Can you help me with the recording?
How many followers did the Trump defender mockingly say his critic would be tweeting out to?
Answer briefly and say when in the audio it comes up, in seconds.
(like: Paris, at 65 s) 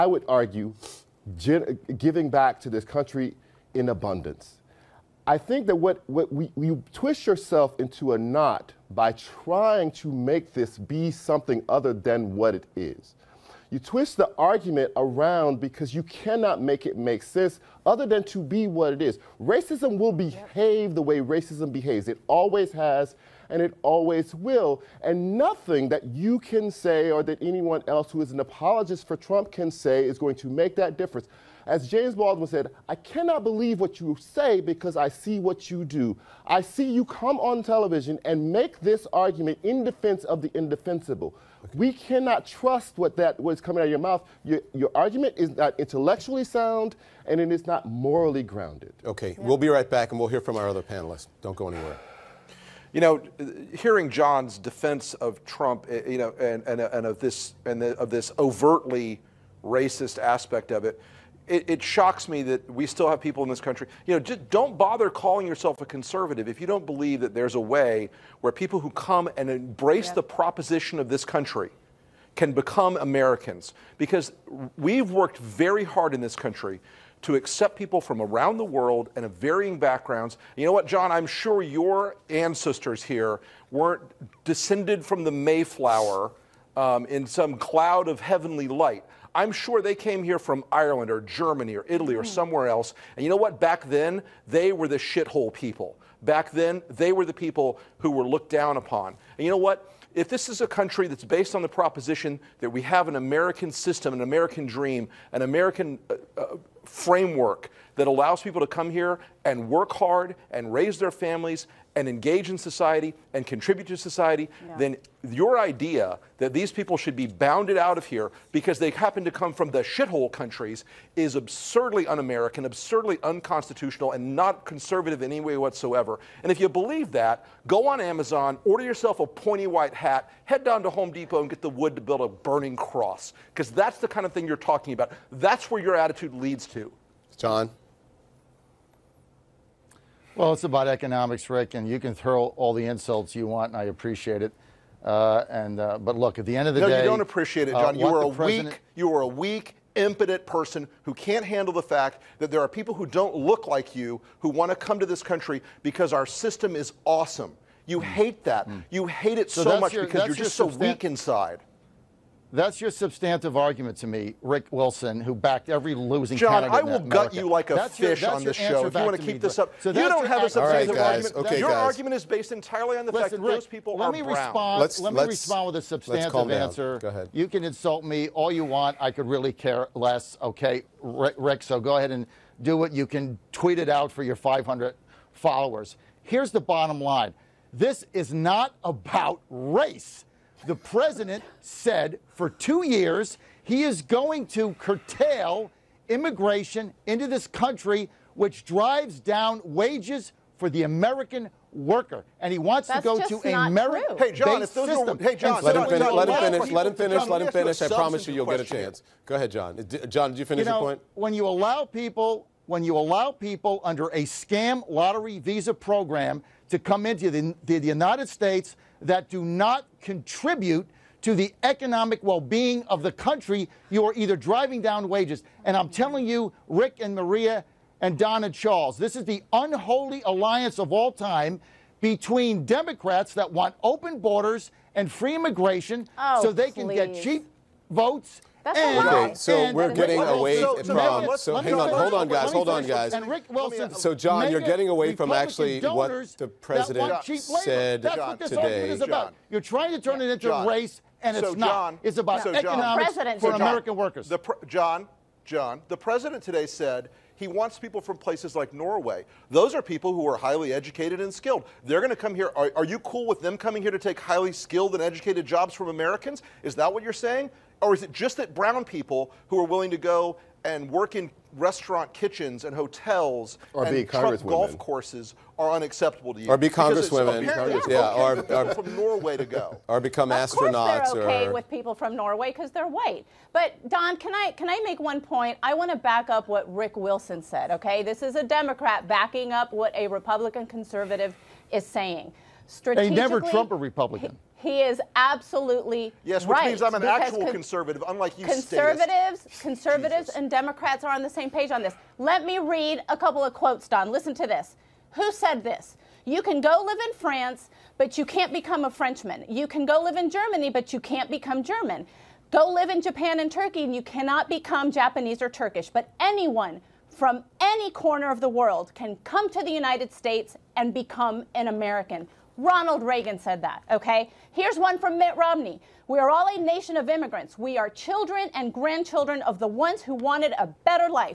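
500, at 184 s.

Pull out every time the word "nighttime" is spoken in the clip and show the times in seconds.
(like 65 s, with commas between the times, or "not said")
not said.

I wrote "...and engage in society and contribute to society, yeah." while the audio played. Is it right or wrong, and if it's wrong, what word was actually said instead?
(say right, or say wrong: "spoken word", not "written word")
right.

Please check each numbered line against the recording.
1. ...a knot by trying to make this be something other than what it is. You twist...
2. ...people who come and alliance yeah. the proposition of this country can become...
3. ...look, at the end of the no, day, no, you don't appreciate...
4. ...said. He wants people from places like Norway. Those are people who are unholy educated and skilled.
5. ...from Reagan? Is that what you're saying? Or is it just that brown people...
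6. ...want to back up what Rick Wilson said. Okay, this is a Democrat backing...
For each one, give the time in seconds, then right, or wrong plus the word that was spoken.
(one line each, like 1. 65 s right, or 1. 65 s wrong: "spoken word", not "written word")
1. 8 s right
2. 68 s wrong: "embrace", not "alliance"
3. 146 s right
4. 256 s wrong: "highly", not "unholy"
5. 265 s wrong: "Americans", not "Reagan"
6. 285 s right.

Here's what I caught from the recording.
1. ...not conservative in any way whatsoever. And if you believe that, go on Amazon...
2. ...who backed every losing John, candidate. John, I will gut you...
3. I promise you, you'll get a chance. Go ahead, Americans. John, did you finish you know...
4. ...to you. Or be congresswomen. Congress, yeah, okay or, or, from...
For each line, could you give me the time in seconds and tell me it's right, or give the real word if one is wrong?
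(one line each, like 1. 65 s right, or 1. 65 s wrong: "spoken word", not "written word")
1. 124 s right
2. 165 s right
3. 207 s wrong: "John", not "Americans"
4. 276 s right.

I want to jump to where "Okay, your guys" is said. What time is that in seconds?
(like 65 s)
171 s.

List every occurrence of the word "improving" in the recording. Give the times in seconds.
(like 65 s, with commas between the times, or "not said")
not said.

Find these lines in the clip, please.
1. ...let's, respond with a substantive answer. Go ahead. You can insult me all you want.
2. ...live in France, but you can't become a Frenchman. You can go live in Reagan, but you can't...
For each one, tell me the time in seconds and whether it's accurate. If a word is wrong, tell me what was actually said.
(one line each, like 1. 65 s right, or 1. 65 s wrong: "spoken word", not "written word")
1. 175 s right
2. 306 s wrong: "Germany", not "Reagan".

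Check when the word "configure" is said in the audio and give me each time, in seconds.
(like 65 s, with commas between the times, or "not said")
not said.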